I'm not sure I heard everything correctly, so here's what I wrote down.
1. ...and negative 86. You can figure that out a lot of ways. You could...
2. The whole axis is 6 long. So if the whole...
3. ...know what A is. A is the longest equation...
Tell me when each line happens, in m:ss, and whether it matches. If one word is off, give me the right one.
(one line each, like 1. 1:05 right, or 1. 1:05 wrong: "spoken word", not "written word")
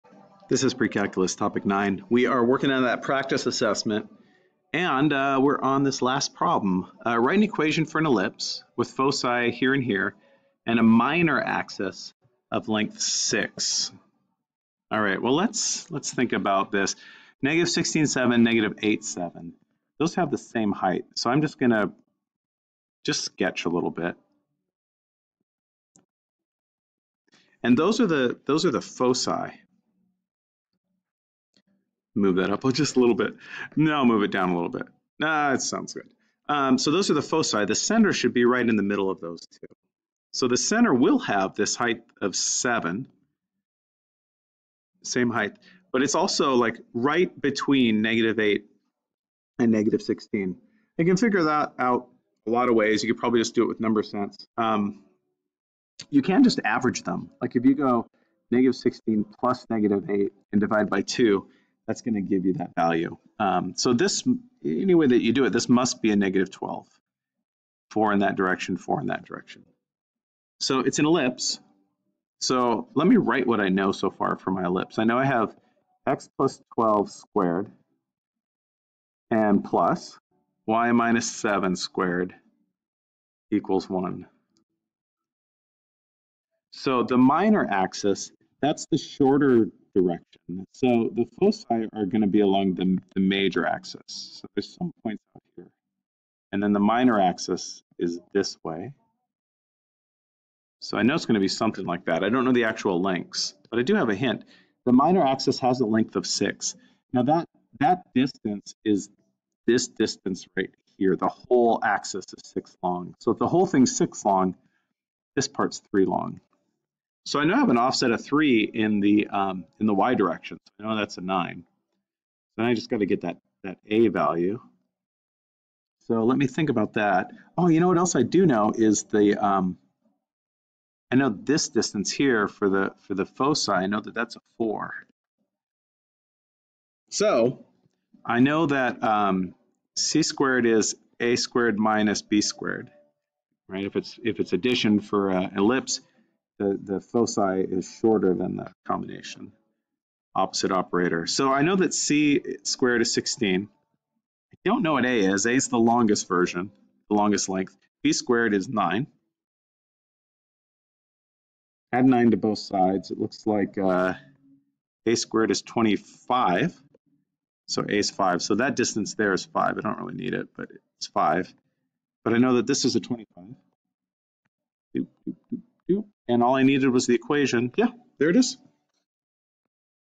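1. 0:49 wrong: "16", not "86"
2. 1:51 right
3. 2:34 wrong: "version", not "equation".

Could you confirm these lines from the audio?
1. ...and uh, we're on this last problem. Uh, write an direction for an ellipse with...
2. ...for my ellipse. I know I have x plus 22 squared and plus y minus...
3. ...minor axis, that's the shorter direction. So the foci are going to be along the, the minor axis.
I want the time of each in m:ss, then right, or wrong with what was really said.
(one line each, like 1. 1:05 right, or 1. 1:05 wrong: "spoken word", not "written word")
1. 0:04 wrong: "equation", not "direction"
2. 1:14 wrong: "12", not "22"
3. 1:27 wrong: "major", not "minor".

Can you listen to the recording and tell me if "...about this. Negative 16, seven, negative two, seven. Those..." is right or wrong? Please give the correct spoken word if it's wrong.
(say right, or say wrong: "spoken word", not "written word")
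wrong: "eight", not "two".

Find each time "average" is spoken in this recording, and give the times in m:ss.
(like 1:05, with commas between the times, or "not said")
0:56.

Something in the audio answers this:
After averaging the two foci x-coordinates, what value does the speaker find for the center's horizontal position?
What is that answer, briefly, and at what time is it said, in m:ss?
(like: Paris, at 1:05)
-12, at 1:06.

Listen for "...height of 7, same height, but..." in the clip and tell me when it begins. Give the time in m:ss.
0:41.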